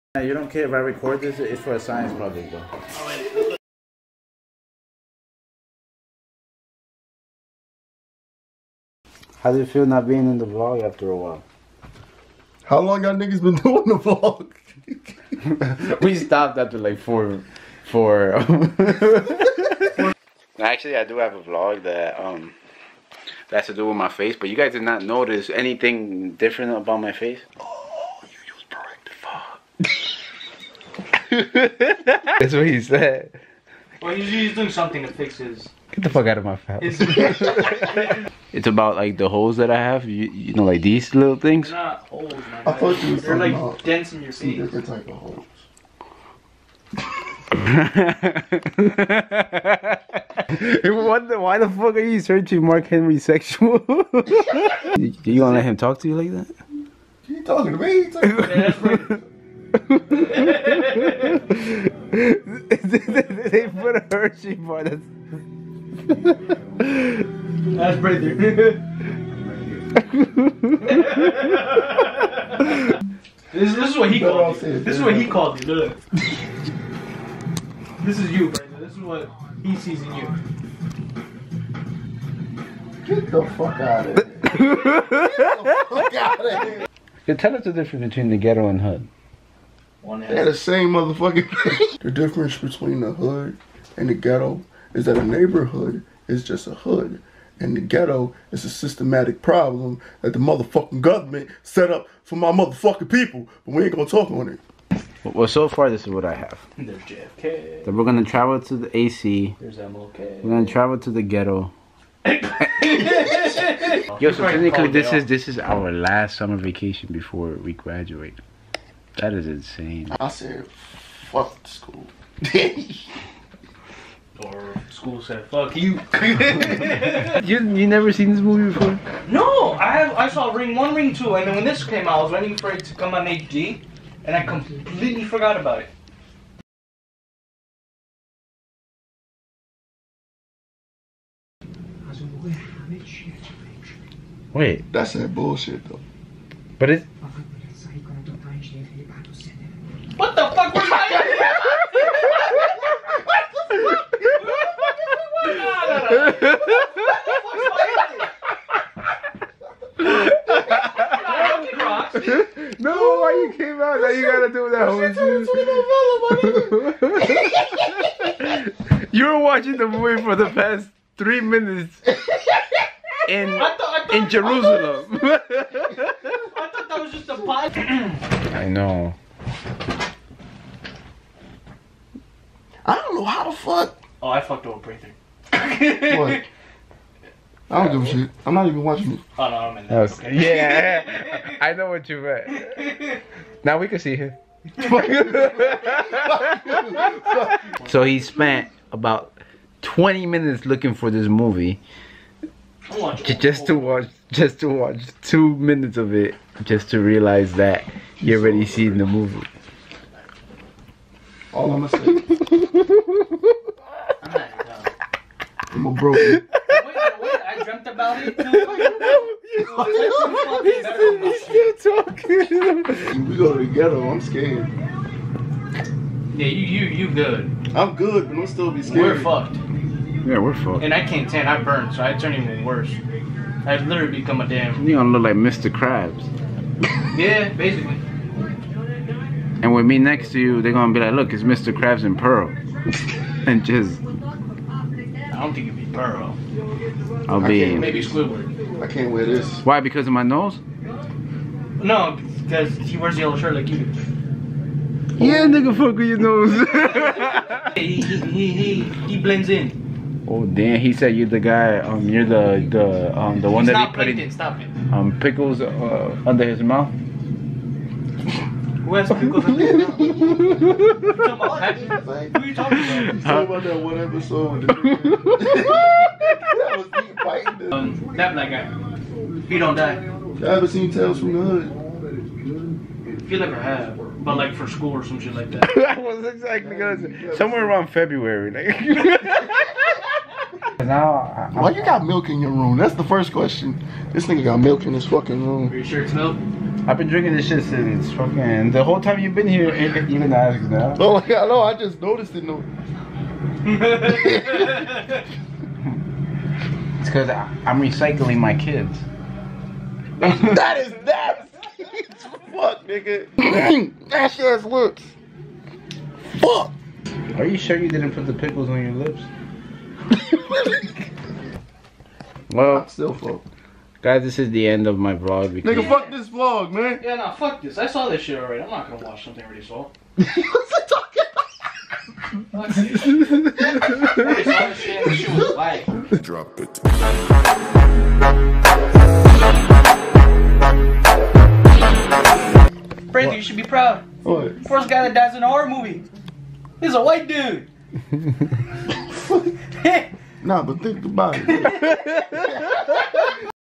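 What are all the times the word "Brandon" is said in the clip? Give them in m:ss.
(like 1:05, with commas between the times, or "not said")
1:18, 5:43.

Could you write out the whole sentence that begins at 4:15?
Yeah, nigga, fuck with your nose.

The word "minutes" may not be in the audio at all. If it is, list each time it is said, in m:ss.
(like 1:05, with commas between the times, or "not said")
2:51, 3:20, 3:25.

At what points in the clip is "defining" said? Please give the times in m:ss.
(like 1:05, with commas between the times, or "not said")
not said.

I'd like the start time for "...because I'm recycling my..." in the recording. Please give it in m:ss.
5:07.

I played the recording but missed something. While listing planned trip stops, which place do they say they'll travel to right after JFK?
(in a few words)
the AC.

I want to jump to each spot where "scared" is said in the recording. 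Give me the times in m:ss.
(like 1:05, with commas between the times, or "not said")
3:44, 3:48.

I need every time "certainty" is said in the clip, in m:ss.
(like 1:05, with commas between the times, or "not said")
not said.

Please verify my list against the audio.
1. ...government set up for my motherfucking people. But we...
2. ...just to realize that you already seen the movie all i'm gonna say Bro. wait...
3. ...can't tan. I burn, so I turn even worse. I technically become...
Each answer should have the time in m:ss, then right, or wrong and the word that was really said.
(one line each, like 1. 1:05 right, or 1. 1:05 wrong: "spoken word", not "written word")
1. 1:41 right
2. 3:26 right
3. 3:51 wrong: "literally", not "technically".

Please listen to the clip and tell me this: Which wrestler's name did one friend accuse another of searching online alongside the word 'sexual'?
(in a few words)
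Mark Henry.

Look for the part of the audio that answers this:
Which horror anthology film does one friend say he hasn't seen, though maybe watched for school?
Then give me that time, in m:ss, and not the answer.
4:40.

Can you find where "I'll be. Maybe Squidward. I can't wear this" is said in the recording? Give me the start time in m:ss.
4:07.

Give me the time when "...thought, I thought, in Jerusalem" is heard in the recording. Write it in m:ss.
2:53.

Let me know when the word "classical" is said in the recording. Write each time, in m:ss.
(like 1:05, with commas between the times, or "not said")
not said.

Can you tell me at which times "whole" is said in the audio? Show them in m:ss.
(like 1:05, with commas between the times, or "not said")
2:48, 4:58.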